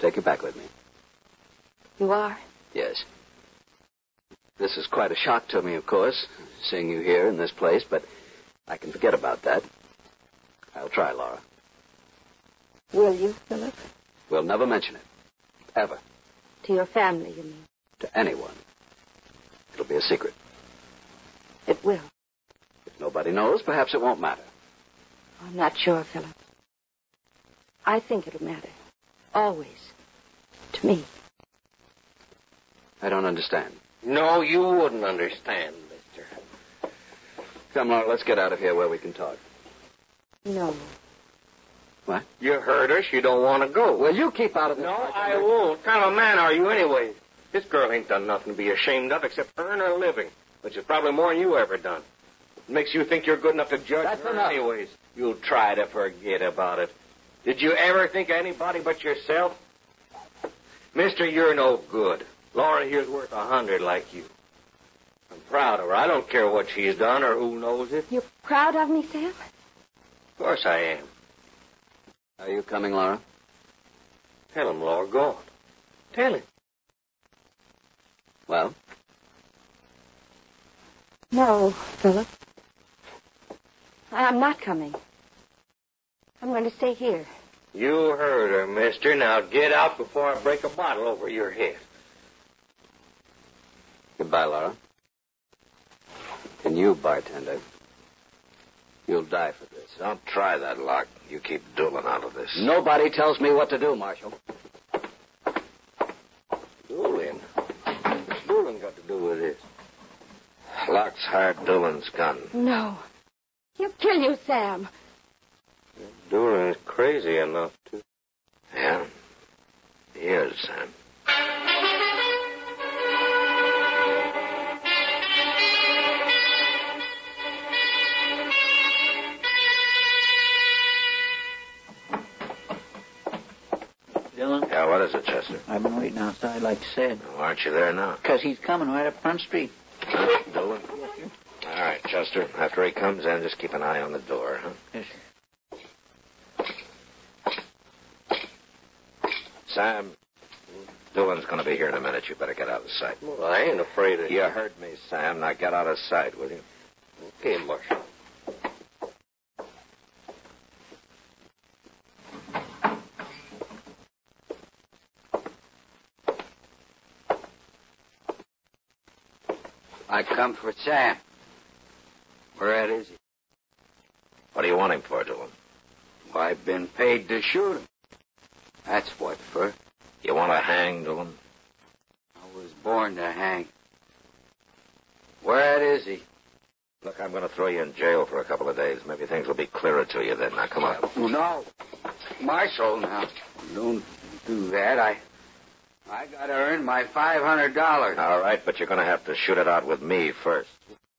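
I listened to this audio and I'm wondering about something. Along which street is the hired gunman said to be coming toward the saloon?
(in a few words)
Front Street.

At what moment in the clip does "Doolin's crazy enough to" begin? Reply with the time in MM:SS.
01:56.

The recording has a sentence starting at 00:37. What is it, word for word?
Come, Laura, let's get out of here where we can talk.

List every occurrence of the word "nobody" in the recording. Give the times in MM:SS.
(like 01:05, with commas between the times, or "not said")
00:22, 01:42.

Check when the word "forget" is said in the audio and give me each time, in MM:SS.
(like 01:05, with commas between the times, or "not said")
00:08, 00:55.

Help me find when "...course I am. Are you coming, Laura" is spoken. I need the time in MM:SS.
01:10.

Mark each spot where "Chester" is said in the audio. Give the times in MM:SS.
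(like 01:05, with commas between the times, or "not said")
02:15, 02:22.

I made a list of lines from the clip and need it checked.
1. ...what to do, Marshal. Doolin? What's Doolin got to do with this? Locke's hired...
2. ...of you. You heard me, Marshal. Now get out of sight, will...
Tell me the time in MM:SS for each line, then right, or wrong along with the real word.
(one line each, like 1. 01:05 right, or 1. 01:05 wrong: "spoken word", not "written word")
1. 01:43 right
2. 02:34 wrong: "Sam", not "Marshal".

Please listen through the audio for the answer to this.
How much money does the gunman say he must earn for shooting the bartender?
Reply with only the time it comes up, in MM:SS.
03:17.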